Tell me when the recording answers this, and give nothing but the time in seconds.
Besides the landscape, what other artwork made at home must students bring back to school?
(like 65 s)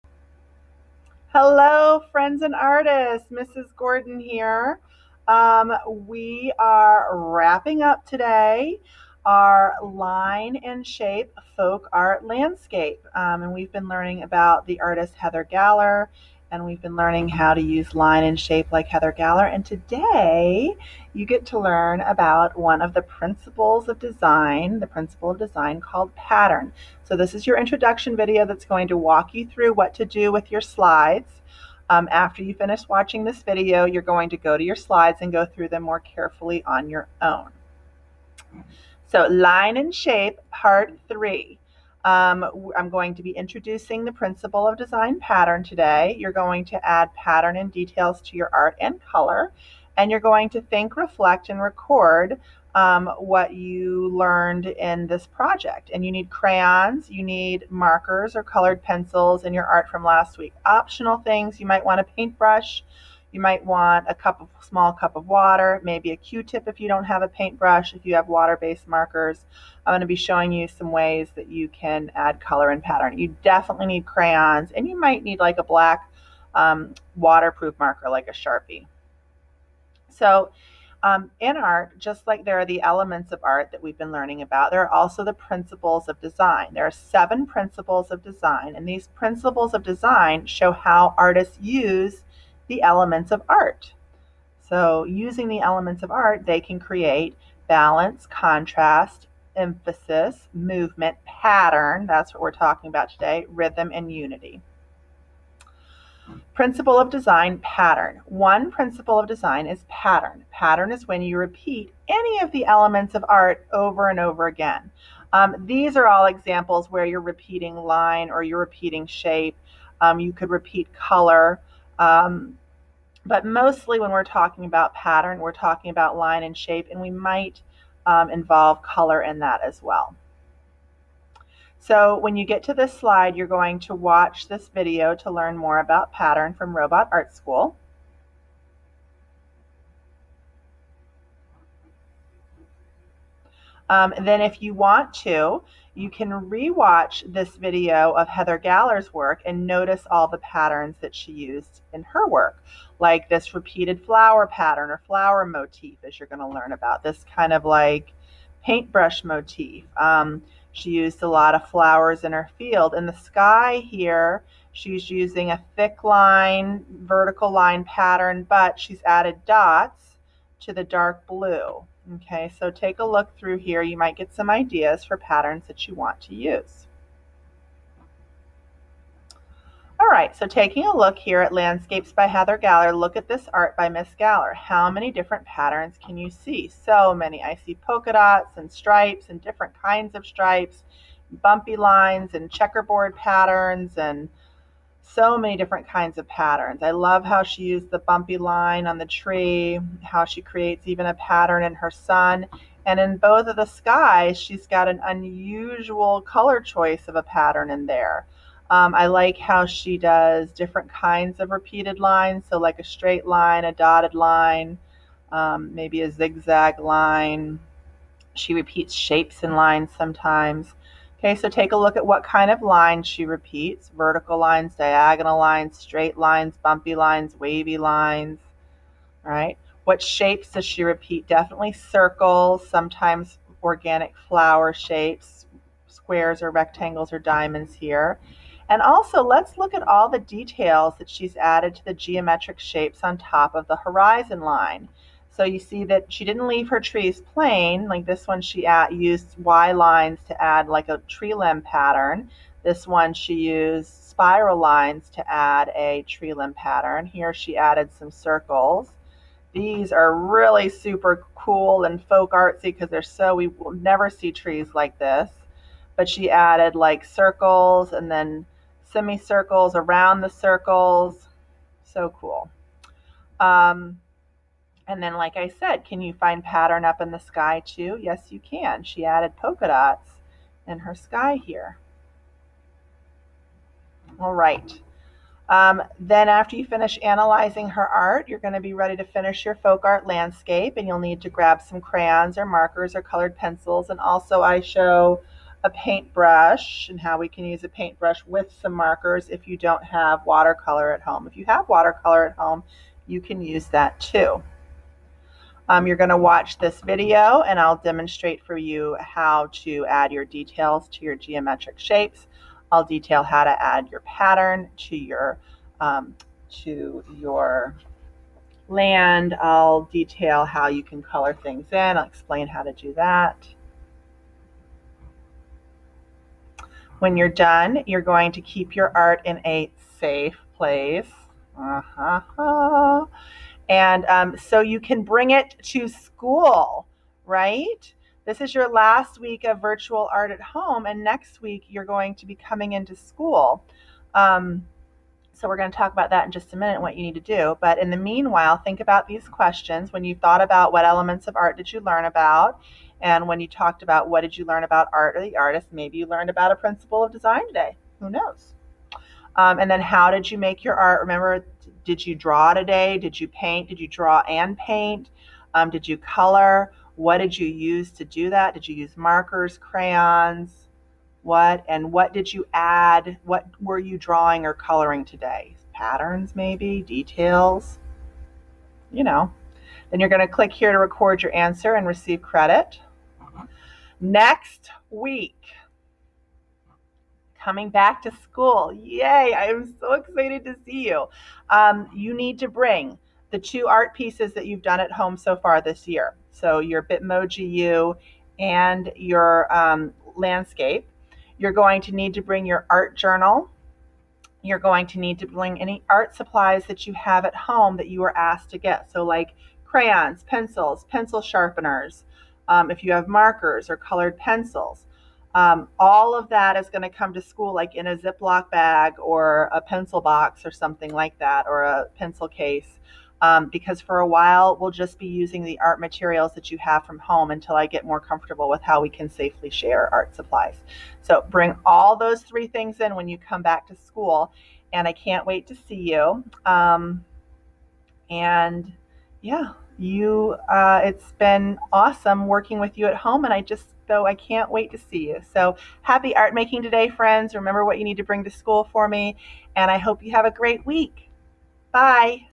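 396 s.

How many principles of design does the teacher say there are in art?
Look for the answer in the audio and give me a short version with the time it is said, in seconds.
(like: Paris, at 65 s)
7, at 86 s.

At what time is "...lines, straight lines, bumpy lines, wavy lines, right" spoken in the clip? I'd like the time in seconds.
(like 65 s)
225 s.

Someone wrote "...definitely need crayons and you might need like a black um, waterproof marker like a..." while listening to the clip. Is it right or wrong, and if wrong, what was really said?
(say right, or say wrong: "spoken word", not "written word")
right.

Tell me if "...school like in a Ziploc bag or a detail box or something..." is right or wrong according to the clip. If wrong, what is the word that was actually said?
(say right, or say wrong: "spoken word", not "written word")
wrong: "pencil", not "detail".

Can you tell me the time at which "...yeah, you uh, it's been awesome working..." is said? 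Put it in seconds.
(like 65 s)
439 s.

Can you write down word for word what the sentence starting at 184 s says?
How many different patterns can you see?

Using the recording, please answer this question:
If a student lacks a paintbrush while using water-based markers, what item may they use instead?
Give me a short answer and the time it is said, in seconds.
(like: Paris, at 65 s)
A Q-tip, at 66 s.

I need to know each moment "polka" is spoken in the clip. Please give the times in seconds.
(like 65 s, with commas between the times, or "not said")
187 s, 279 s.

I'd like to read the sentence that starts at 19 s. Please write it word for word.
And today you get to learn about one of the principles of design, the principle of design called pattern.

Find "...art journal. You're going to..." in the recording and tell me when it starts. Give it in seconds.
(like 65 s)
402 s.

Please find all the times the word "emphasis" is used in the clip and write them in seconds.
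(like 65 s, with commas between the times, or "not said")
99 s.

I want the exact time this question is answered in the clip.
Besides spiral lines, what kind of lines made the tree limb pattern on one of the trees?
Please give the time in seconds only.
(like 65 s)
249 s.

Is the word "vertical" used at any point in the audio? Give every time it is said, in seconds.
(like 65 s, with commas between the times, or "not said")
167 s, 223 s.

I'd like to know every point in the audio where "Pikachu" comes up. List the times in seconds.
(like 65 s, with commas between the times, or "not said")
not said.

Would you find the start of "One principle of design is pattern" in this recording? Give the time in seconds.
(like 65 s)
108 s.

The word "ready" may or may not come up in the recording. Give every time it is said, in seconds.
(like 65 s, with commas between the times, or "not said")
288 s.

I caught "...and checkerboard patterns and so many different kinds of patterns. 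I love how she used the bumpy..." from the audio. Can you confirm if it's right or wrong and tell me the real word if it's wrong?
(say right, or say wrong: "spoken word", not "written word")
right.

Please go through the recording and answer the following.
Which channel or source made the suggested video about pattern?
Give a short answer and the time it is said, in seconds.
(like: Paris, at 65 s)
Robot Art School, at 136 s.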